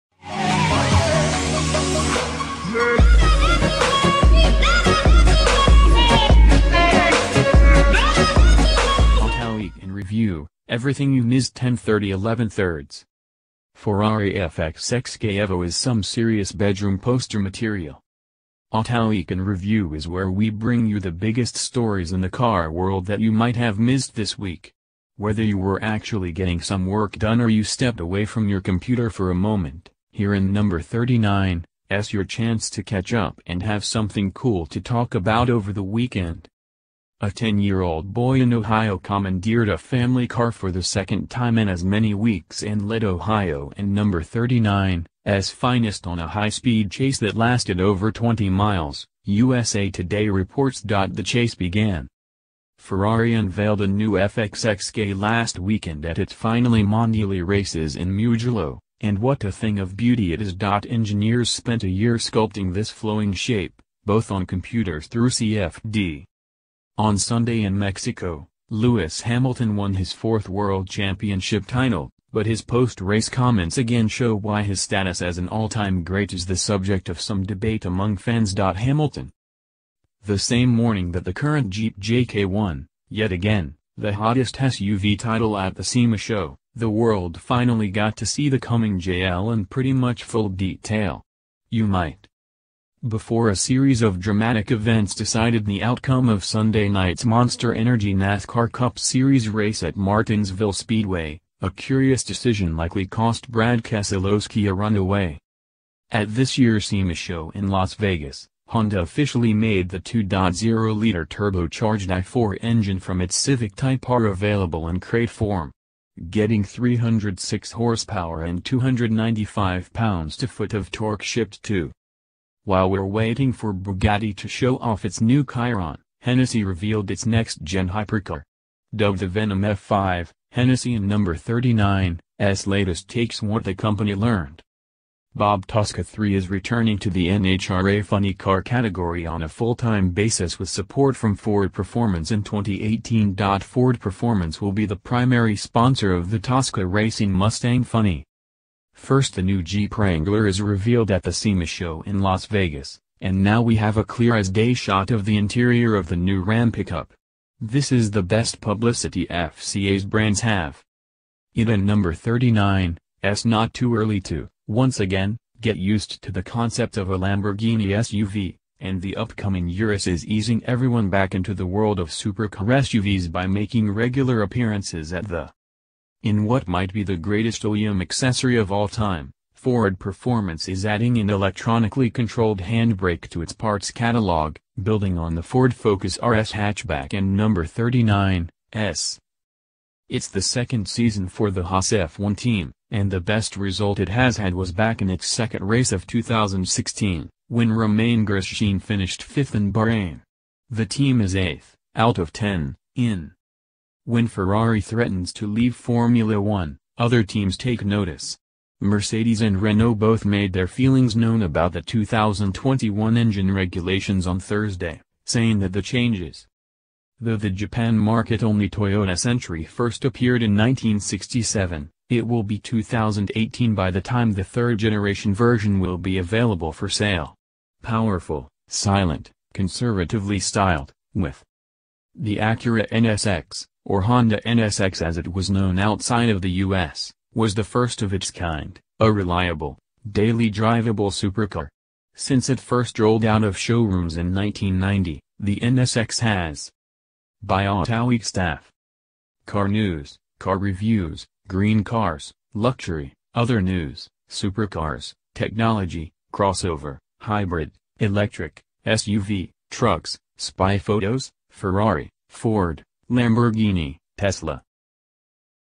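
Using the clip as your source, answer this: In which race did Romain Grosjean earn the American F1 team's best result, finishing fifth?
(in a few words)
Bahrain.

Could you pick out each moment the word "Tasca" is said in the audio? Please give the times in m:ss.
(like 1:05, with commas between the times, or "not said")
2:15, 2:26.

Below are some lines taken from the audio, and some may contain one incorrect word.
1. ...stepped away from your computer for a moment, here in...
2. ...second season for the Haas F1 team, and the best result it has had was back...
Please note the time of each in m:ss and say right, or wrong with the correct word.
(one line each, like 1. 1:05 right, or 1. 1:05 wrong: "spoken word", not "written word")
1. 0:27 right
2. 3:10 right.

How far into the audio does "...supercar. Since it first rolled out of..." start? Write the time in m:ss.
4:01.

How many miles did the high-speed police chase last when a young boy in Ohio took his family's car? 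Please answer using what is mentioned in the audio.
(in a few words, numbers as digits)
20 miles.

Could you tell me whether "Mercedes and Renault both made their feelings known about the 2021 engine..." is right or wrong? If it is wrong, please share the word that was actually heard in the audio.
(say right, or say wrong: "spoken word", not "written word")
right.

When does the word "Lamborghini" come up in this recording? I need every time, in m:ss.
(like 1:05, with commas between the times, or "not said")
2:47, 4:23.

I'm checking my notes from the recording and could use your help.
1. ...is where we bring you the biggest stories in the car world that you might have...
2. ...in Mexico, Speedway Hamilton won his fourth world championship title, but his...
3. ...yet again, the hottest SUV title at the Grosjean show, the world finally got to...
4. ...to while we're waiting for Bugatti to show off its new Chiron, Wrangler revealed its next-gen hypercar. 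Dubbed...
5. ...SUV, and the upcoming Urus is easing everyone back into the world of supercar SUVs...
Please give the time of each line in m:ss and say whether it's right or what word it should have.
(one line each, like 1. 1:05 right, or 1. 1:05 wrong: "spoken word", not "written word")
1. 0:19 right
2. 1:07 wrong: "Lewis", not "Speedway"
3. 1:23 wrong: "SEMA", not "Grosjean"
4. 2:01 wrong: "Hennessy", not "Wrangler"
5. 2:47 right.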